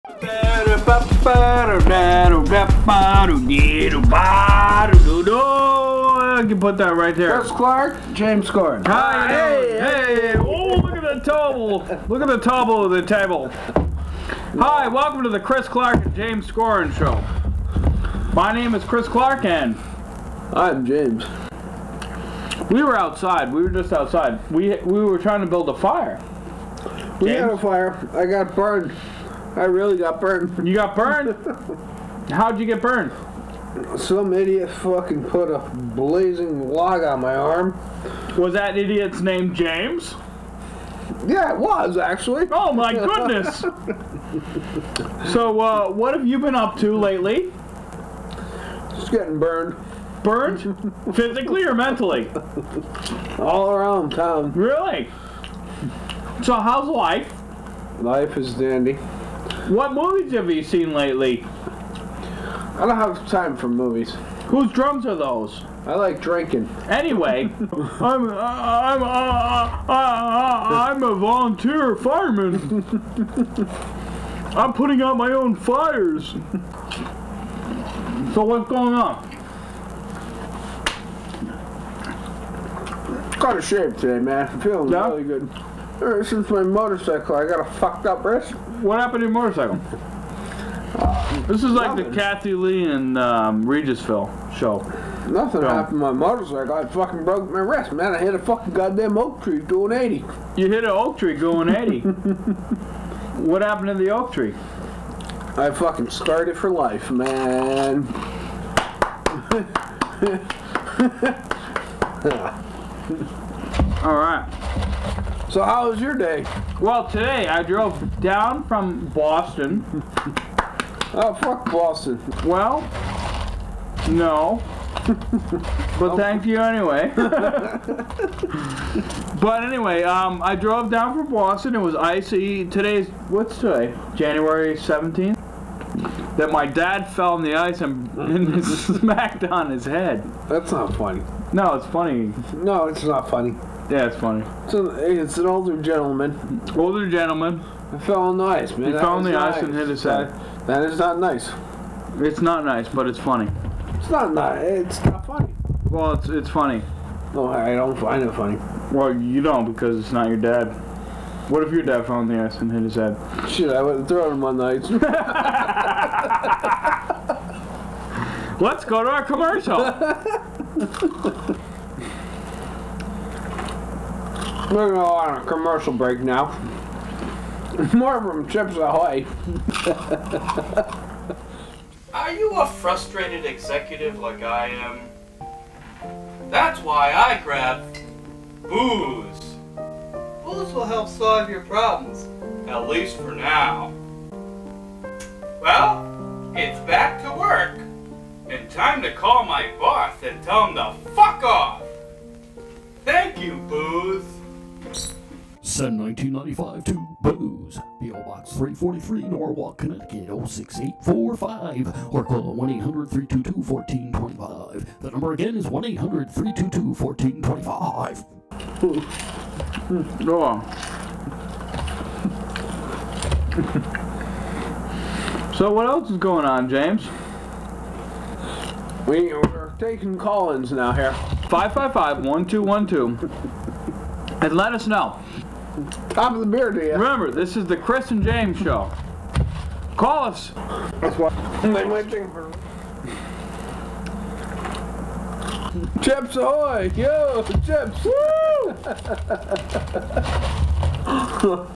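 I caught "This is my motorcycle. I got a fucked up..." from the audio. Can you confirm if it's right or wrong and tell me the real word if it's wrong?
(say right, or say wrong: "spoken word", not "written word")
right.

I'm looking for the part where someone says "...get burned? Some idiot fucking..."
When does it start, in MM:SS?
00:32.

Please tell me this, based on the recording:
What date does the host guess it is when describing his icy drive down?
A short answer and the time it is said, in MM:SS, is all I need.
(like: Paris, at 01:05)
January 17th, at 02:14.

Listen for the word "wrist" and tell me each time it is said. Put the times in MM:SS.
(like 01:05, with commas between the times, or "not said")
01:28, 01:37.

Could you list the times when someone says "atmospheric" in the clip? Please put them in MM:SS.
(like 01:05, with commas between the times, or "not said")
not said.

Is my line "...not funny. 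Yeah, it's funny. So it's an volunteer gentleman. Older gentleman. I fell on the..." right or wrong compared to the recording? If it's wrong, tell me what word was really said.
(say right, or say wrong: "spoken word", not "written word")
wrong: "older", not "volunteer".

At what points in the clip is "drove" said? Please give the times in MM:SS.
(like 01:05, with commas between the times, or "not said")
01:57, 02:10.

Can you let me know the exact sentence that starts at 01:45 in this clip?
I fucking started for life, man.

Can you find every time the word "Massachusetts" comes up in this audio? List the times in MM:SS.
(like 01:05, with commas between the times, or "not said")
not said.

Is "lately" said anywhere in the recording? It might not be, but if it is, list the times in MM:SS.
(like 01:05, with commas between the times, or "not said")
00:46, 01:00.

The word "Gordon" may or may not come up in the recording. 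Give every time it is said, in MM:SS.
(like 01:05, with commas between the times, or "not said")
00:08, 00:16.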